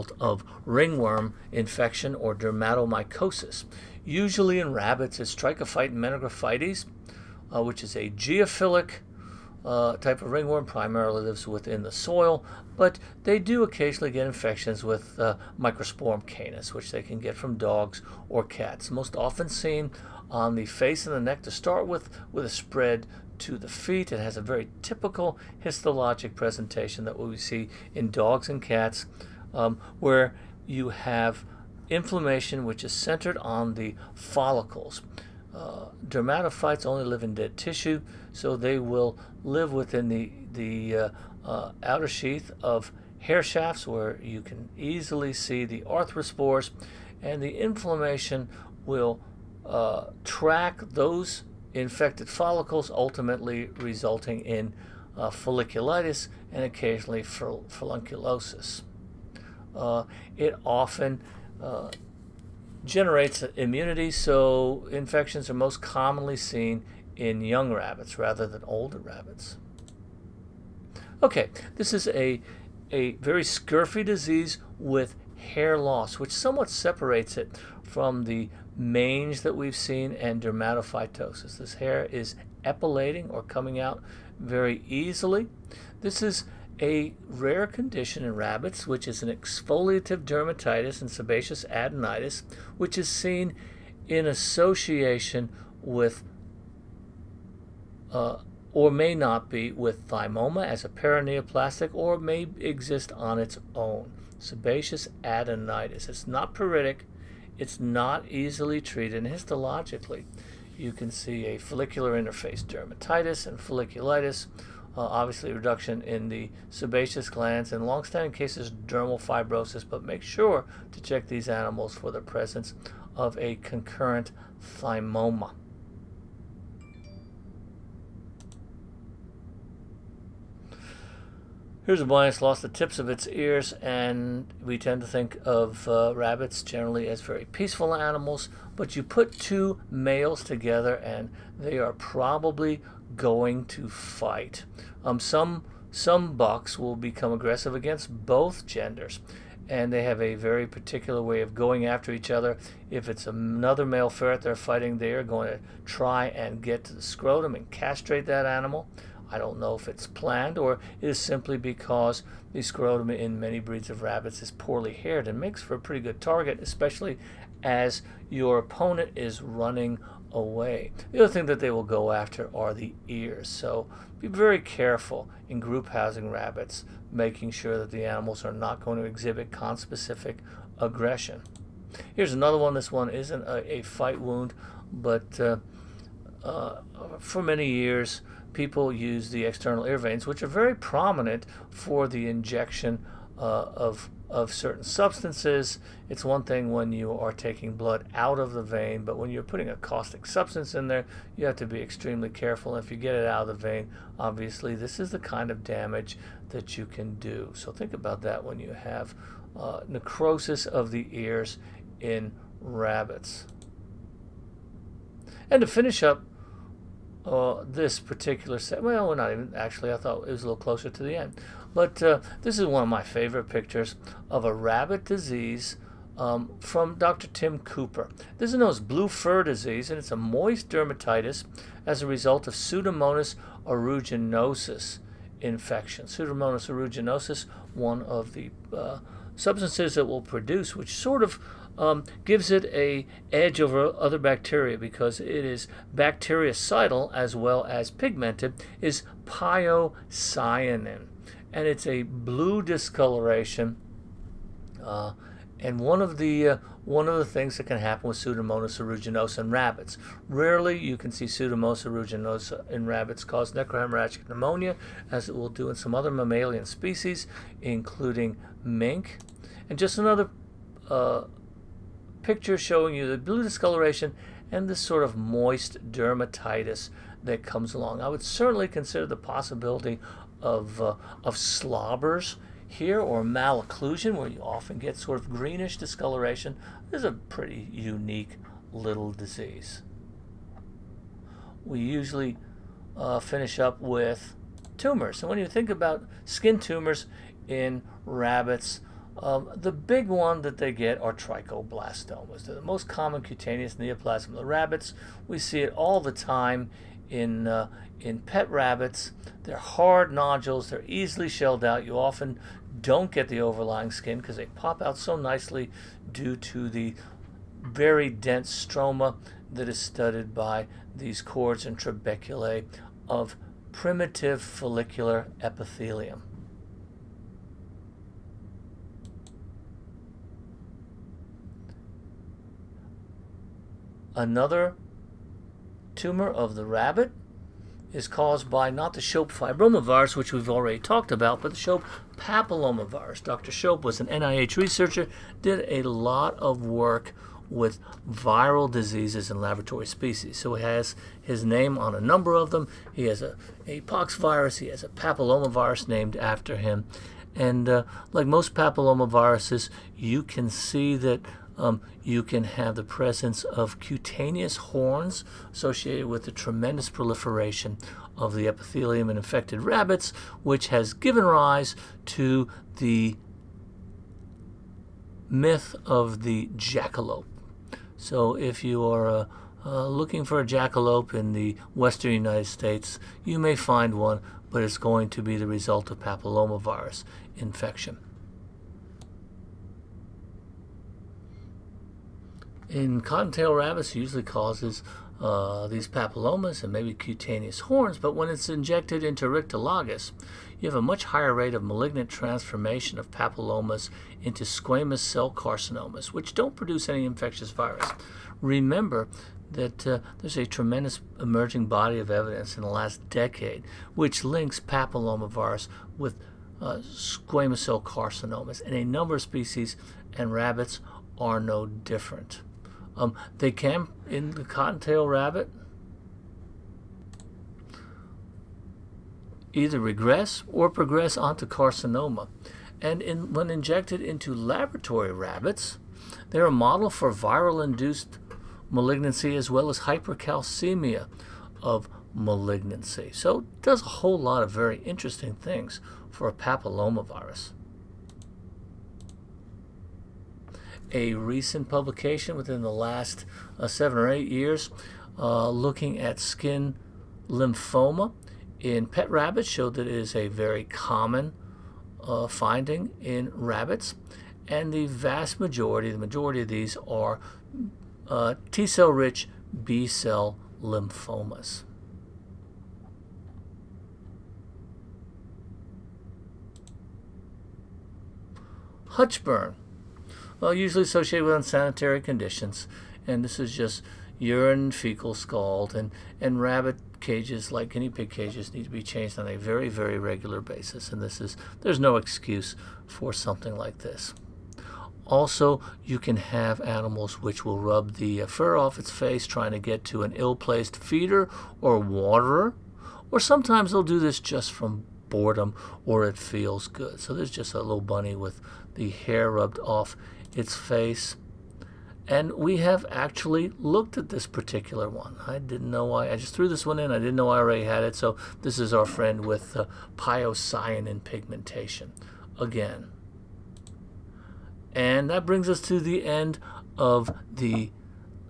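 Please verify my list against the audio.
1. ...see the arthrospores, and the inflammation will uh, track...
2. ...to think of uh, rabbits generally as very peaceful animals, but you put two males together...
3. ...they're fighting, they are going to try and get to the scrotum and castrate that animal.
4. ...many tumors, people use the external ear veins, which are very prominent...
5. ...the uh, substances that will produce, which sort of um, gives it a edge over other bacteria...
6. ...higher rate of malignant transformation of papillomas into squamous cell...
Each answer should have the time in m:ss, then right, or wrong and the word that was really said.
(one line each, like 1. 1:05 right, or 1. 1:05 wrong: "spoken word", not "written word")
1. 0:45 right
2. 2:15 right
3. 2:34 right
4. 3:07 wrong: "years", not "tumors"
5. 3:58 right
6. 6:41 right.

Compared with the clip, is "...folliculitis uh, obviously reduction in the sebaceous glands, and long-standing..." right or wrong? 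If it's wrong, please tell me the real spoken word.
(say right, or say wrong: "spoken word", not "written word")
right.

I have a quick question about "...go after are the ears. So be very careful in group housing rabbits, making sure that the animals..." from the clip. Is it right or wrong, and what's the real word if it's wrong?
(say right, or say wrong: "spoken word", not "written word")
right.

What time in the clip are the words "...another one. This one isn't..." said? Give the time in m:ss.
3:02.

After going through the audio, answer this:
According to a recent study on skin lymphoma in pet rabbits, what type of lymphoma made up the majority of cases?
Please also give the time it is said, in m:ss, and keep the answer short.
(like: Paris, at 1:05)
T cell rich B cell lymphomas, at 7:48.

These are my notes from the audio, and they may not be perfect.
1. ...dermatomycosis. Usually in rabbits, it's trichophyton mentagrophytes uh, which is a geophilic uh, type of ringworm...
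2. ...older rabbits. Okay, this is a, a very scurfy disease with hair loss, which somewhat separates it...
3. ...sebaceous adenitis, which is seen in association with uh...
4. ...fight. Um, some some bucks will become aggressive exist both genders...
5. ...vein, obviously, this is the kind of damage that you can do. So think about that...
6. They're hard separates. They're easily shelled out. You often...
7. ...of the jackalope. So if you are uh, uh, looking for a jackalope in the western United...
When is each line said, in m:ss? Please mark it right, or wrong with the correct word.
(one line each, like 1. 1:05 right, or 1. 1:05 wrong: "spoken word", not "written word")
1. 0:02 right
2. 1:08 right
3. 1:31 right
4. 2:23 wrong: "against", not "exist"
5. 3:23 right
6. 5:09 wrong: "nodules", not "separates"
7. 6:15 right.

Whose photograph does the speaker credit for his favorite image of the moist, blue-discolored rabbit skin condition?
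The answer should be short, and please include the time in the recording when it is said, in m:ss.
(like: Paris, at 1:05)
Dr. Tim Cooper, at 3:46.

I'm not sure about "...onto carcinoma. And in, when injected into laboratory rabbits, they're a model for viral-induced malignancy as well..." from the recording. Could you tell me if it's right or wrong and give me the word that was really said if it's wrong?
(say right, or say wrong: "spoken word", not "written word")
right.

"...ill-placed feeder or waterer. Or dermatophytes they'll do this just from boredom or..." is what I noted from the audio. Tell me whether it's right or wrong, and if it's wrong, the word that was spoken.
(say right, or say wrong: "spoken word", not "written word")
wrong: "sometimes", not "dermatophytes".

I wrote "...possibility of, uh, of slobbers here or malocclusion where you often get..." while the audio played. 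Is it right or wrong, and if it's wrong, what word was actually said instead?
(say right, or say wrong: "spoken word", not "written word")
right.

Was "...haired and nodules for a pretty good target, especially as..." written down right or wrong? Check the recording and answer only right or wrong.
wrong.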